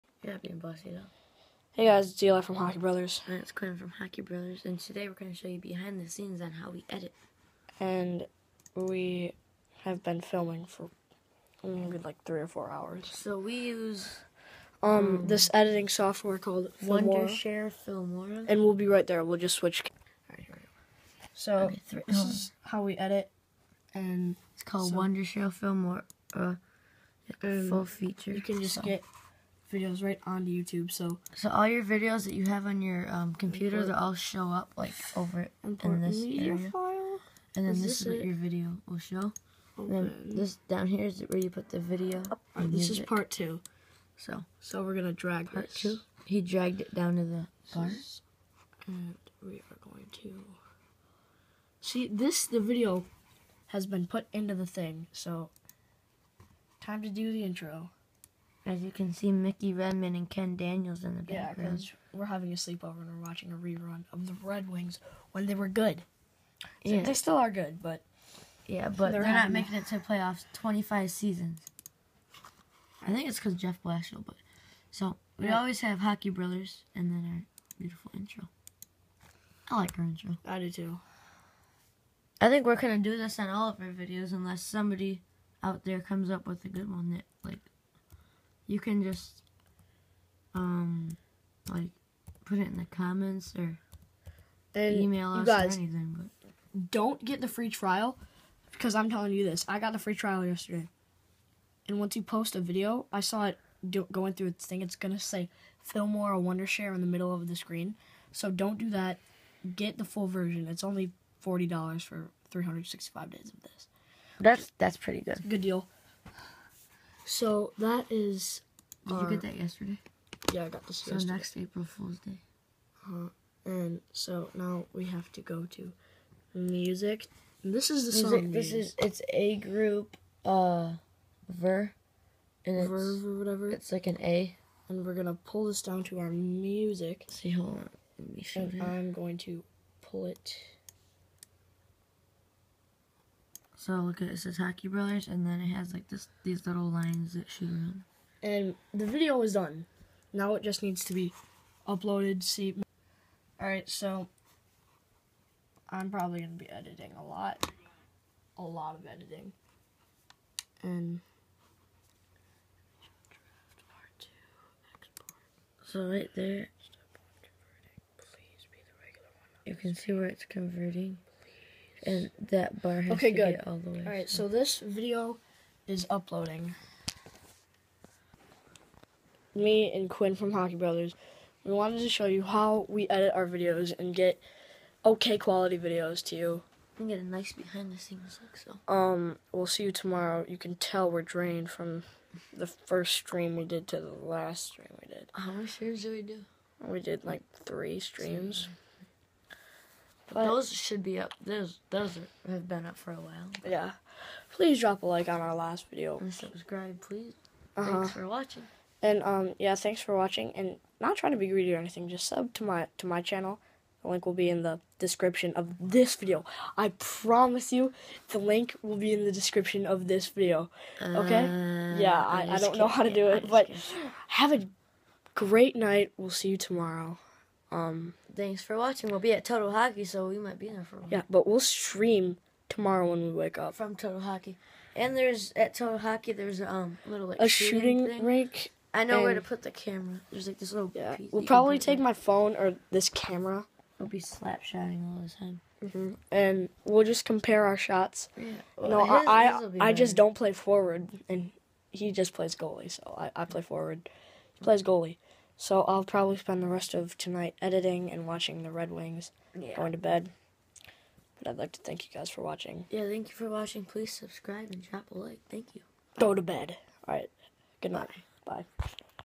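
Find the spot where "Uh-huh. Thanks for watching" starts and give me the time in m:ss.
3:27.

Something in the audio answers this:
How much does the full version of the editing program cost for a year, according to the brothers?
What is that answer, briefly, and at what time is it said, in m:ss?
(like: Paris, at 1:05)
$40, at 1:51.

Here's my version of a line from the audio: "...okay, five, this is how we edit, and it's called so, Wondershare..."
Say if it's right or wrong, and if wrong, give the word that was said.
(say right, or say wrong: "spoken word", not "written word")
wrong: "three", not "five".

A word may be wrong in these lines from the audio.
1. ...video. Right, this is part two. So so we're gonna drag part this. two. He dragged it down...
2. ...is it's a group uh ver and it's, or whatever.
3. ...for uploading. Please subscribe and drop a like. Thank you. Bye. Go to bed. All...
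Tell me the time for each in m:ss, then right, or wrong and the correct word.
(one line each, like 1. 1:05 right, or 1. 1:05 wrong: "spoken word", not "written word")
1. 0:41 right
2. 2:08 right
3. 4:23 wrong: "watching", not "uploading".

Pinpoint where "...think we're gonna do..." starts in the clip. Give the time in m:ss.
1:22.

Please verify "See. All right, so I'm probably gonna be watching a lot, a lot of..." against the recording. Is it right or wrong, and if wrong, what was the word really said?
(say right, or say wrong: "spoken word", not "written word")
wrong: "editing", not "watching".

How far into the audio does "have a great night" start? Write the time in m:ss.
3:44.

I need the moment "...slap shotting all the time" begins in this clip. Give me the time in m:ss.
4:04.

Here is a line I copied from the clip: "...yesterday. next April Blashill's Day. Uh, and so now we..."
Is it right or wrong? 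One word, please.
wrong.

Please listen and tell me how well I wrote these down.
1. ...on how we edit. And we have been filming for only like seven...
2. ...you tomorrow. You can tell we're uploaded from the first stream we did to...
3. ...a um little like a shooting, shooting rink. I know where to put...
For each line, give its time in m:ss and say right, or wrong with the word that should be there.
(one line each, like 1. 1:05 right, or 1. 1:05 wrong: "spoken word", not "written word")
1. 0:06 wrong: "three", not "seven"
2. 3:09 wrong: "drained", not "uploaded"
3. 3:56 right.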